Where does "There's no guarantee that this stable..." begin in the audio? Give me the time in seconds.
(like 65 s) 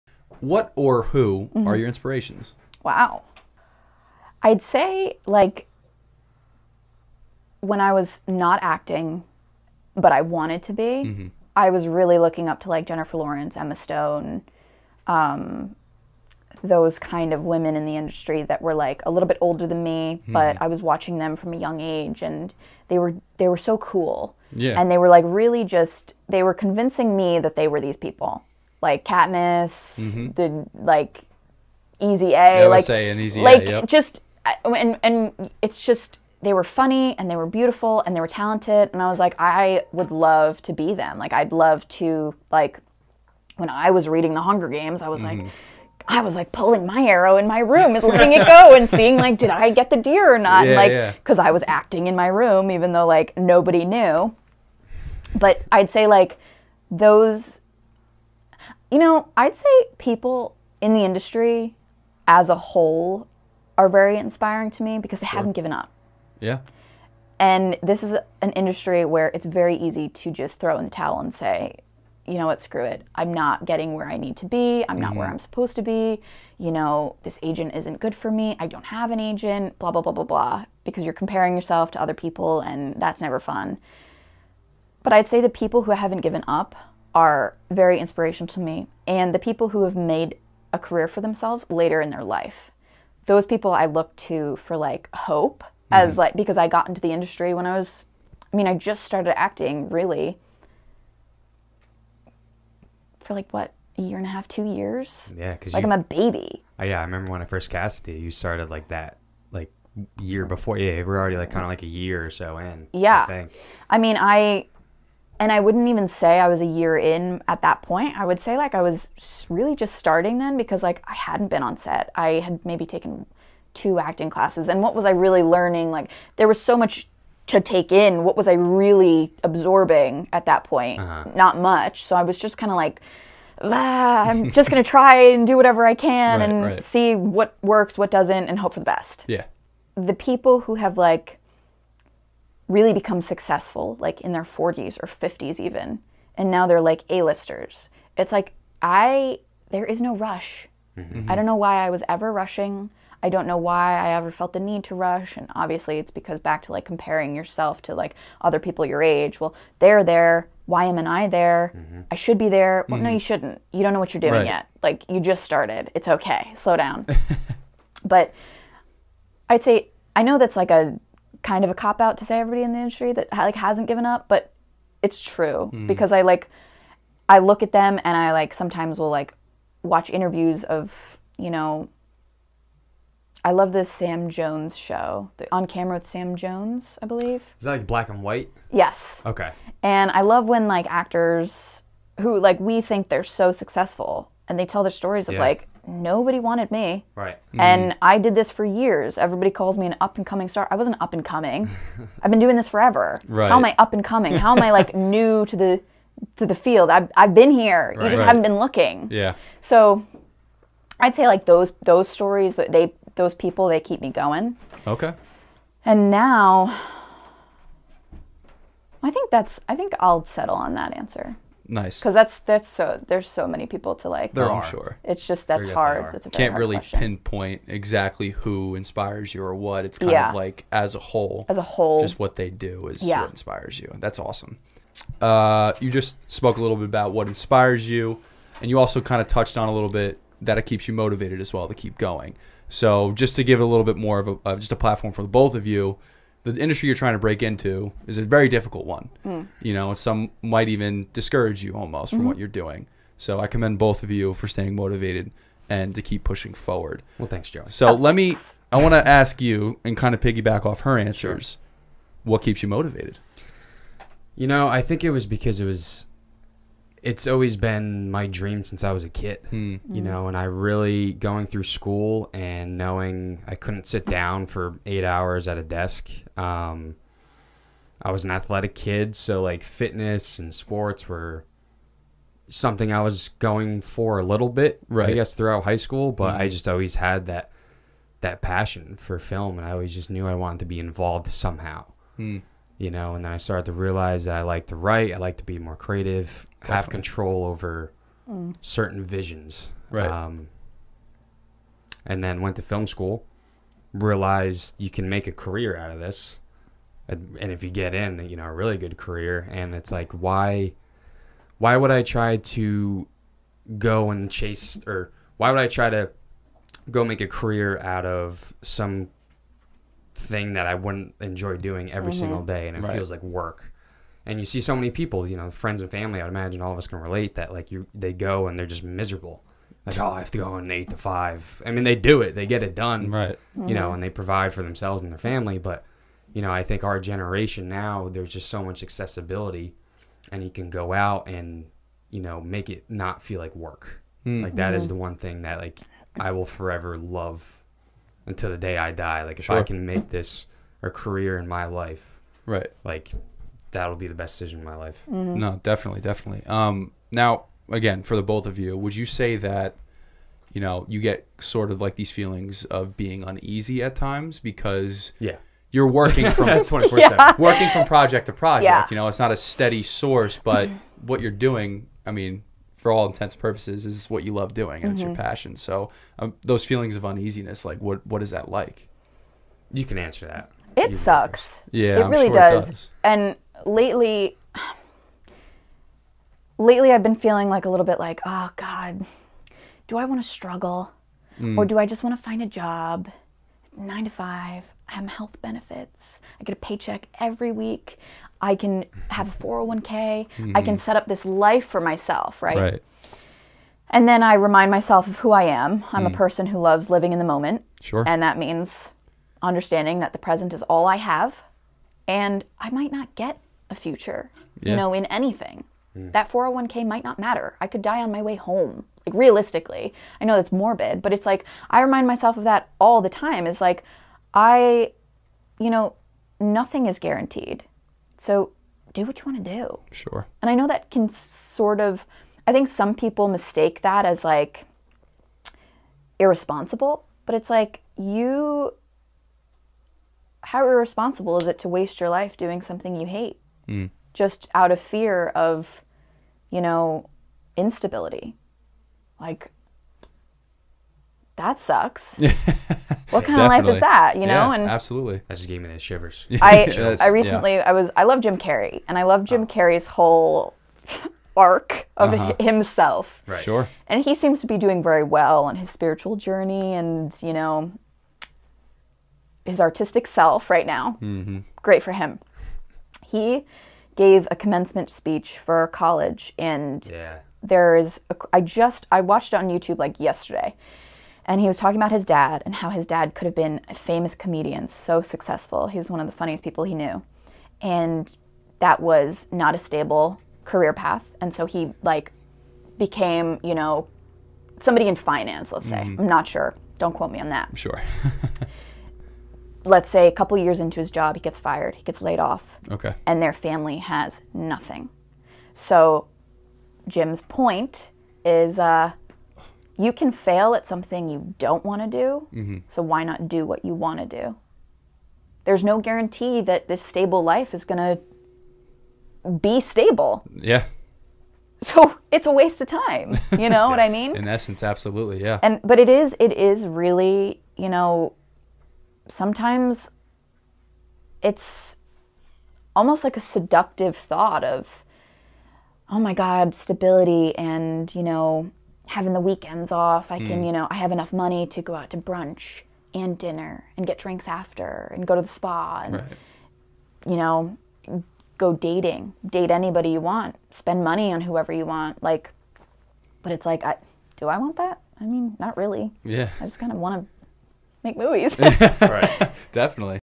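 515 s.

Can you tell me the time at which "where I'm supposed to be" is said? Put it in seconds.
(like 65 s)
75 s.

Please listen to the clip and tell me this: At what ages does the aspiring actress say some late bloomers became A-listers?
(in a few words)
40s or 50s.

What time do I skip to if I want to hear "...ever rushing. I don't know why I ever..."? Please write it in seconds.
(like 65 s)
152 s.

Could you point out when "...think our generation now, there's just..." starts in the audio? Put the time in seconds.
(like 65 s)
336 s.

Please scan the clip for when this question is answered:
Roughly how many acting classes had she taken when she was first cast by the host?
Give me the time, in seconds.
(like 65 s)
123 s.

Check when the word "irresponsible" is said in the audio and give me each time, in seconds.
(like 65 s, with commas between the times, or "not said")
436 s, 440 s.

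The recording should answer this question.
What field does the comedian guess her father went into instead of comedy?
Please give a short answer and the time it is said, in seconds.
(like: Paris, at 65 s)
finance, at 494 s.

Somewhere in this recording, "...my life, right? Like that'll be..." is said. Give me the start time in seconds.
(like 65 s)
351 s.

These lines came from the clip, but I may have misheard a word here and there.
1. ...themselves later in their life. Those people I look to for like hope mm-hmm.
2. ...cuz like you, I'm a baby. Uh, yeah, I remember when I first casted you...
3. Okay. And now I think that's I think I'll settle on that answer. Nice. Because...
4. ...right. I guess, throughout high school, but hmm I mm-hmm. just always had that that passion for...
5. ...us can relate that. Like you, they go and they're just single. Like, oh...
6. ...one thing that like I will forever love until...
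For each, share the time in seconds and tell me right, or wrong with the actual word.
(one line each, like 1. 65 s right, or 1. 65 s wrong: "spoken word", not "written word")
1. 91 s right
2. 105 s right
3. 214 s right
4. 284 s right
5. 326 s wrong: "miserable", not "single"
6. 344 s right.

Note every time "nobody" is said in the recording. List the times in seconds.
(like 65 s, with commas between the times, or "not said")
53 s, 195 s.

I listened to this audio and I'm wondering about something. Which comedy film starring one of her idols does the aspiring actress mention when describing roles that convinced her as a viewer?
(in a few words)
Easy A.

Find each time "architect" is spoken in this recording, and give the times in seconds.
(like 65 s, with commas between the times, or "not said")
not said.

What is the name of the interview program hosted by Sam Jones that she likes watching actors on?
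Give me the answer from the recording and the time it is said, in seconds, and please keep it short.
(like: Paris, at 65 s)
On Camera, at 185 s.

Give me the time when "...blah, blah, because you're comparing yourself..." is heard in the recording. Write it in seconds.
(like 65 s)
80 s.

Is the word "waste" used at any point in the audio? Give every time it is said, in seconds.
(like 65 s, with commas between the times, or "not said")
441 s, 522 s.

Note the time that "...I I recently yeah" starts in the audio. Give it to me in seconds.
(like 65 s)
456 s.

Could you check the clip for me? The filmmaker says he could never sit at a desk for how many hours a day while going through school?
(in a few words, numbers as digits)
8.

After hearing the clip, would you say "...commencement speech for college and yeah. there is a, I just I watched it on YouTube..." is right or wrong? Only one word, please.
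right.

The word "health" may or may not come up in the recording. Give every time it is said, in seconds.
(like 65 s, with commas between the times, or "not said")
395 s.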